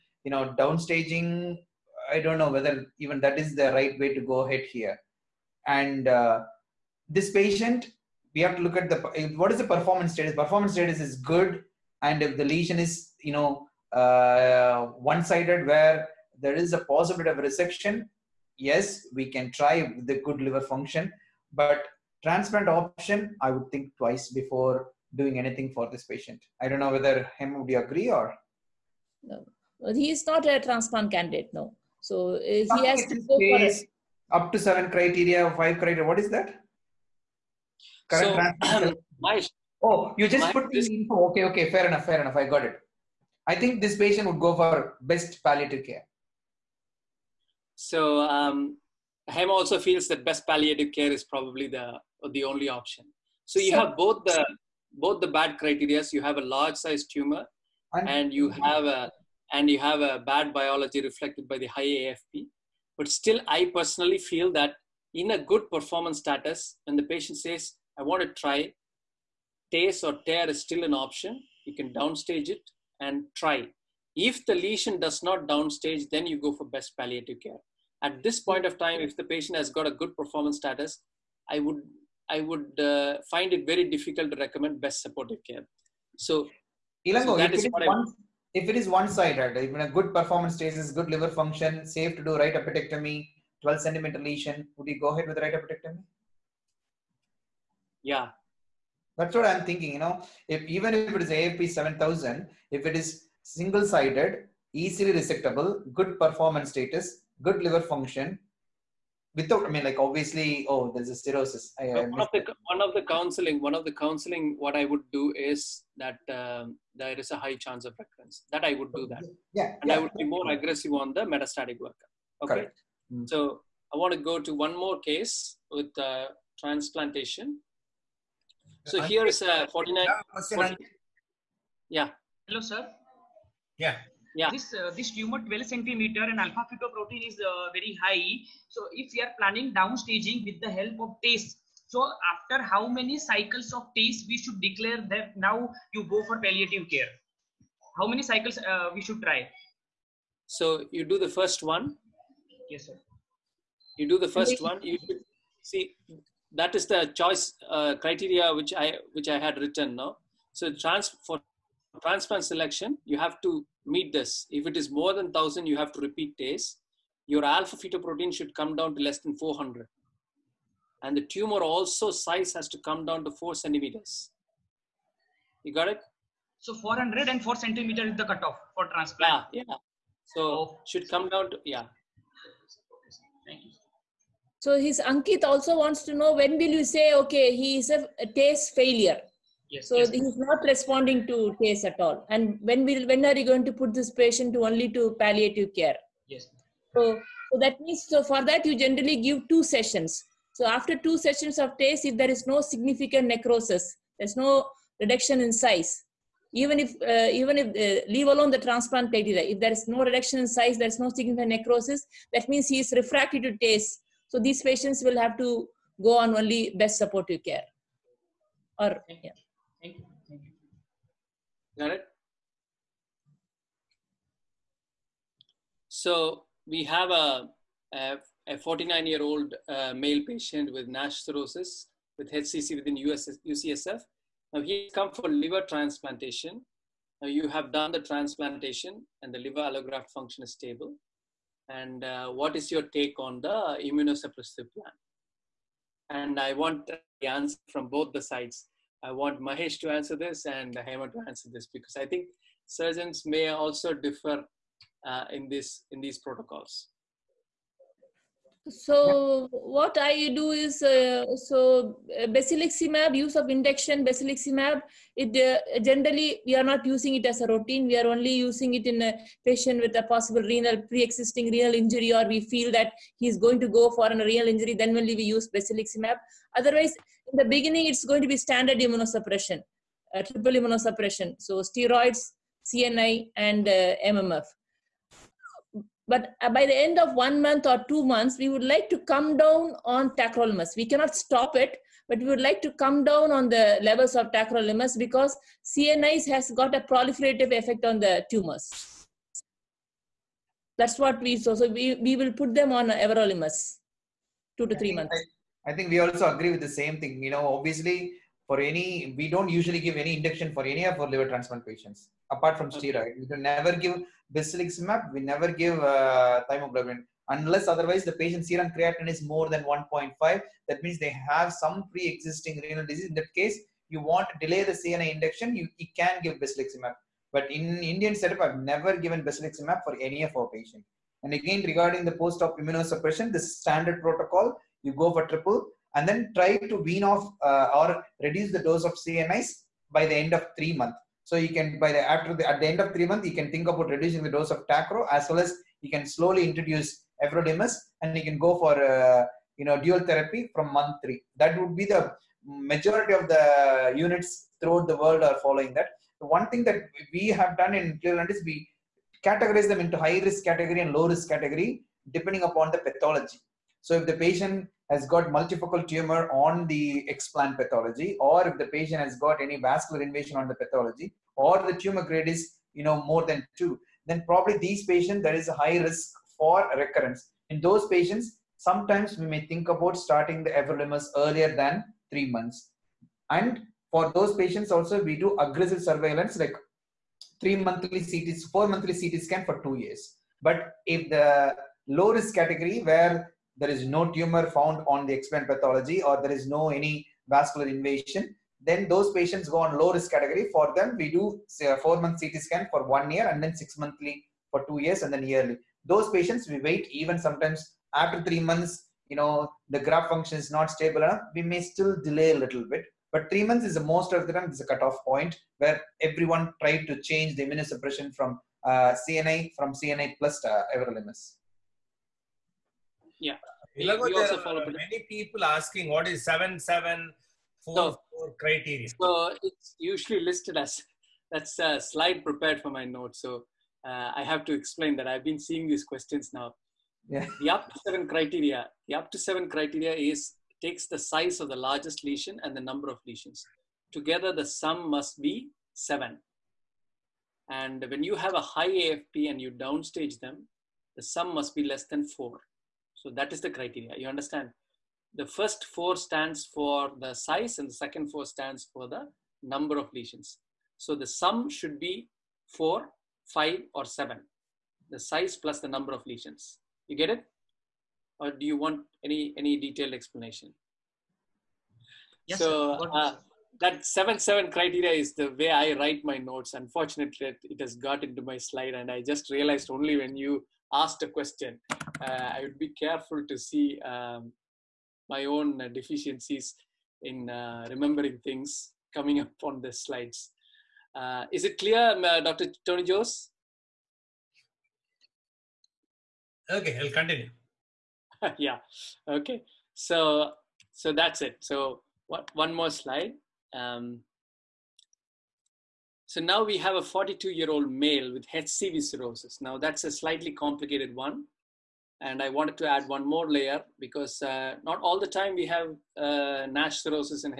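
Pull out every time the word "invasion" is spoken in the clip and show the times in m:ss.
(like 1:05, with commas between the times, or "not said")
6:10, 6:37.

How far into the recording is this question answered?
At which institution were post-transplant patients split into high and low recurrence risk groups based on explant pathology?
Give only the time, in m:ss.
5:57.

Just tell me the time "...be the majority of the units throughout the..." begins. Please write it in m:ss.
5:51.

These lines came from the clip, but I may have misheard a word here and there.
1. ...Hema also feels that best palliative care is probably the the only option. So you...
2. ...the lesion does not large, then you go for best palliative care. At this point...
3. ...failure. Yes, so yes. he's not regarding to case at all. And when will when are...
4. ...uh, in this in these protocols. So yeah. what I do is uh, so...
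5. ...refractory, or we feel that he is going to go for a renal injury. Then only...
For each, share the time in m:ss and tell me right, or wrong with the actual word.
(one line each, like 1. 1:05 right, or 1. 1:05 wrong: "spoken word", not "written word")
1. 0:49 right
2. 1:14 wrong: "downstage", not "large"
3. 3:08 wrong: "responding", not "regarding"
4. 4:15 right
5. 4:31 wrong: "injury", not "refractory".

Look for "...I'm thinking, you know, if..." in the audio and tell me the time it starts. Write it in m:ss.
1:39.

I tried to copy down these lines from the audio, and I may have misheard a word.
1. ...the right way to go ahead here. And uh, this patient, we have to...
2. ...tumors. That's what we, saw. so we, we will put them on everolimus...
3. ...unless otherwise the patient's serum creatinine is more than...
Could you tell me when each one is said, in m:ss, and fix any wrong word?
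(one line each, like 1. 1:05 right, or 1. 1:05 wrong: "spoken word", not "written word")
1. 0:03 right
2. 4:58 right
3. 5:17 right.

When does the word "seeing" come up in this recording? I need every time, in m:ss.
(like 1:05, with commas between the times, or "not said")
7:15.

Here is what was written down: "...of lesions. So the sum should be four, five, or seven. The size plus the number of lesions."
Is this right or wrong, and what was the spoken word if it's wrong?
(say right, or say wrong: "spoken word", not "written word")
right.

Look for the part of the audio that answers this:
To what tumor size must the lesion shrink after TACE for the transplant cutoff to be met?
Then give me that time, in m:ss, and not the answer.
2:53.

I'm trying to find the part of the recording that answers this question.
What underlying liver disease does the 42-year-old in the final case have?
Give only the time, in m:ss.
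8:28.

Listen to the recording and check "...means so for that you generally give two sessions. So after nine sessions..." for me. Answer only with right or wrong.
wrong.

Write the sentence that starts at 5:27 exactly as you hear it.
But in Indian setup, I've never given basiliximab for any of our patients.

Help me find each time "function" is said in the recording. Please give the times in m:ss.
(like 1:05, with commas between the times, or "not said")
0:20, 1:31, 1:47, 4:00, 6:50.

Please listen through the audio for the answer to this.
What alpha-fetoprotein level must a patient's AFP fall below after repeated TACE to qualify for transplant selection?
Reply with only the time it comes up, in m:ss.
2:49.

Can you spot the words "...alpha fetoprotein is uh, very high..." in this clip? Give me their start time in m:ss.
2:16.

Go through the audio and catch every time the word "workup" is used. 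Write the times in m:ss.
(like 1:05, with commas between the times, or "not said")
2:01.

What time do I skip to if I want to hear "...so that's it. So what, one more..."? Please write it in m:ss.
8:20.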